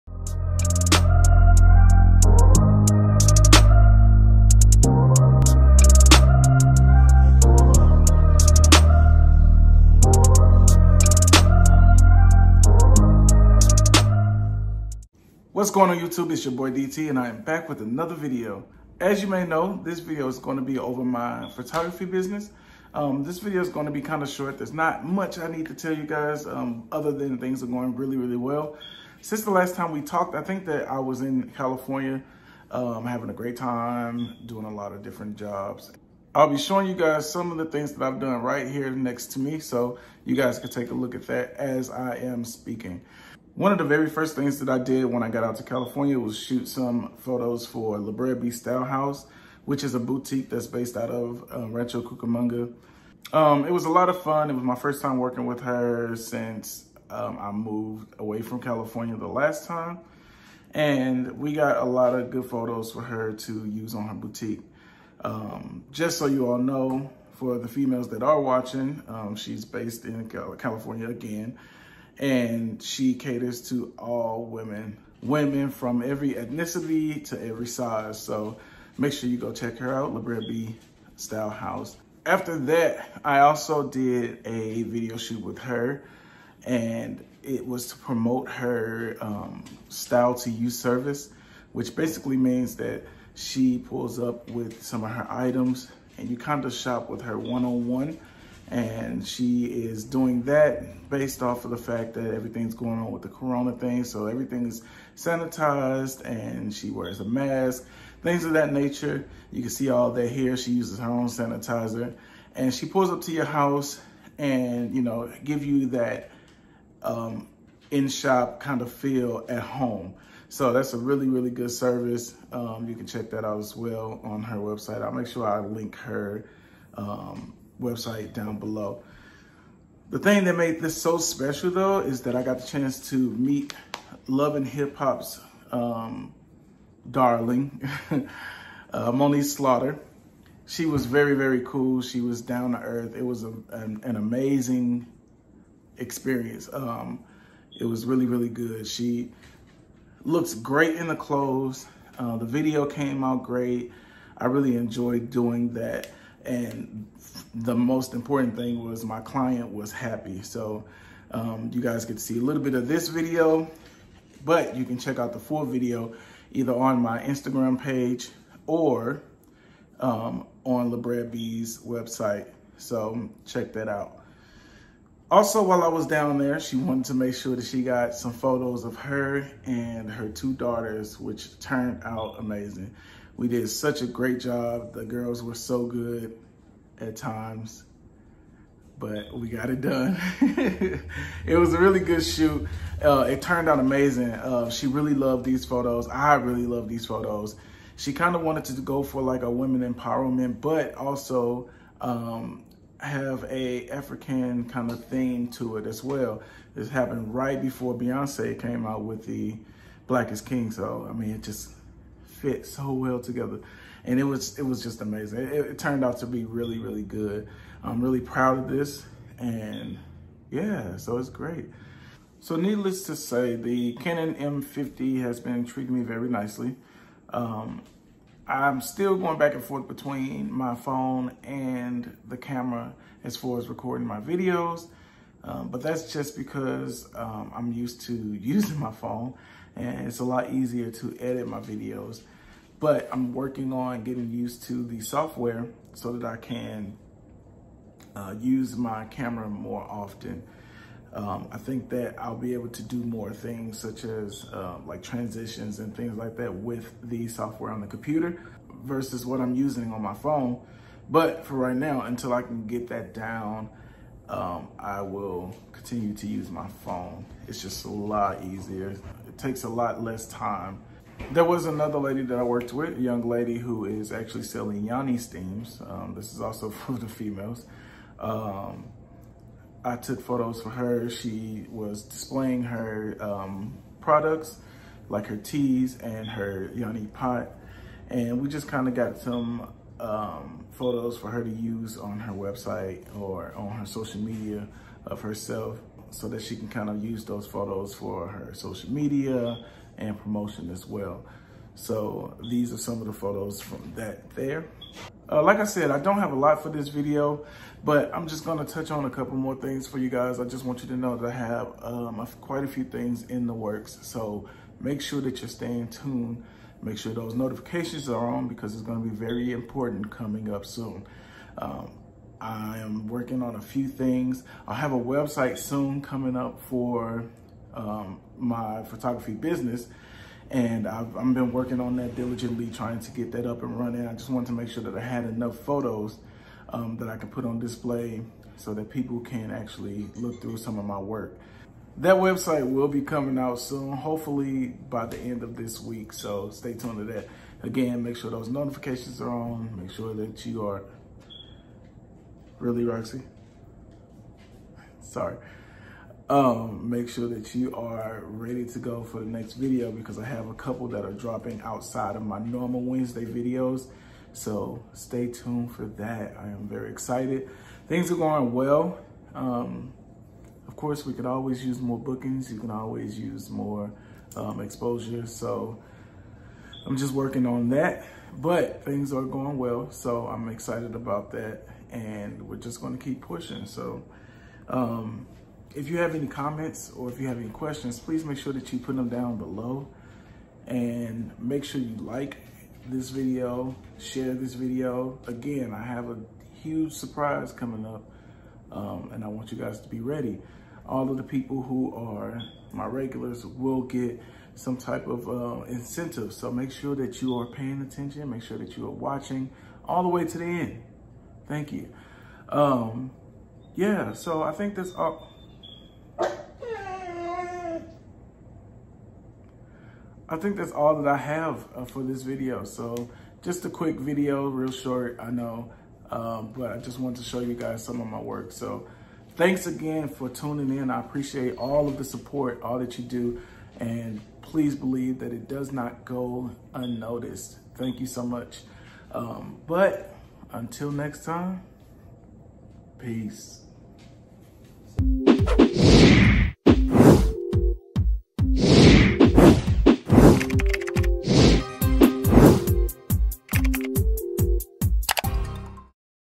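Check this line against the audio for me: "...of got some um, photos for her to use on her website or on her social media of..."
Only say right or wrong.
right.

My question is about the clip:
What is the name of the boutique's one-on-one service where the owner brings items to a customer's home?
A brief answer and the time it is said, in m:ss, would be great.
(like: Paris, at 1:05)
Style to You, at 1:29.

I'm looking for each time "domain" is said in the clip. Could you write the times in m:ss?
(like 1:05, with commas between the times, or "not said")
not said.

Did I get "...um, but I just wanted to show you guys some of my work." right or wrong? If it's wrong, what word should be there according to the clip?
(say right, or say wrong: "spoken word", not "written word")
right.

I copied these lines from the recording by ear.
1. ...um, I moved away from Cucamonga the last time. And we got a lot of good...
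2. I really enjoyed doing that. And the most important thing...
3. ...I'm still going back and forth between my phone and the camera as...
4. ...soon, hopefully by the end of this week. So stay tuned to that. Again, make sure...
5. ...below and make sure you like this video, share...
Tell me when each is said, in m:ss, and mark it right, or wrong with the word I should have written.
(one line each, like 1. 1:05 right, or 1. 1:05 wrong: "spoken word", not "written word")
1. 0:57 wrong: "California", not "Cucamonga"
2. 2:34 right
3. 3:48 right
4. 5:43 right
5. 6:29 right.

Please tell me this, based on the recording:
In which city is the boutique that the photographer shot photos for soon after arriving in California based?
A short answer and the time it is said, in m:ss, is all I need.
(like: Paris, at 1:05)
Rancho Cucamonga, at 0:51.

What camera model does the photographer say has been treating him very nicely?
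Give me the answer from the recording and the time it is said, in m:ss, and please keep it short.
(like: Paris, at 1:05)
Canon M50, at 3:44.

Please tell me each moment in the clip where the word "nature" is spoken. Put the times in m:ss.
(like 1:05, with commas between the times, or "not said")
1:48.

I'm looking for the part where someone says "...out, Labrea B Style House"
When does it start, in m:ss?
1:19.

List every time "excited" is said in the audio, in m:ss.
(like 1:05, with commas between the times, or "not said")
6:06, 6:20.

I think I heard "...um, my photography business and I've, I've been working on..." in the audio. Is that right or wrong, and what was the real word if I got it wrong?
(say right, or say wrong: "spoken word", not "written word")
right.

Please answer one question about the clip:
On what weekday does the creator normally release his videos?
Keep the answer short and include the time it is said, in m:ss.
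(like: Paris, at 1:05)
Wednesday, at 6:02.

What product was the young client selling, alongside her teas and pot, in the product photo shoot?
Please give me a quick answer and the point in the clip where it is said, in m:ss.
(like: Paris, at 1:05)
yoni steams, at 4:34.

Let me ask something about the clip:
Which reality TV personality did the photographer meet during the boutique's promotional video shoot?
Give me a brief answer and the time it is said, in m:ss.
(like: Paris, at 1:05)
Moniece Slaughter, at 2:19.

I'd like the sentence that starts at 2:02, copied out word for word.
Um, you can check that out as well on her website.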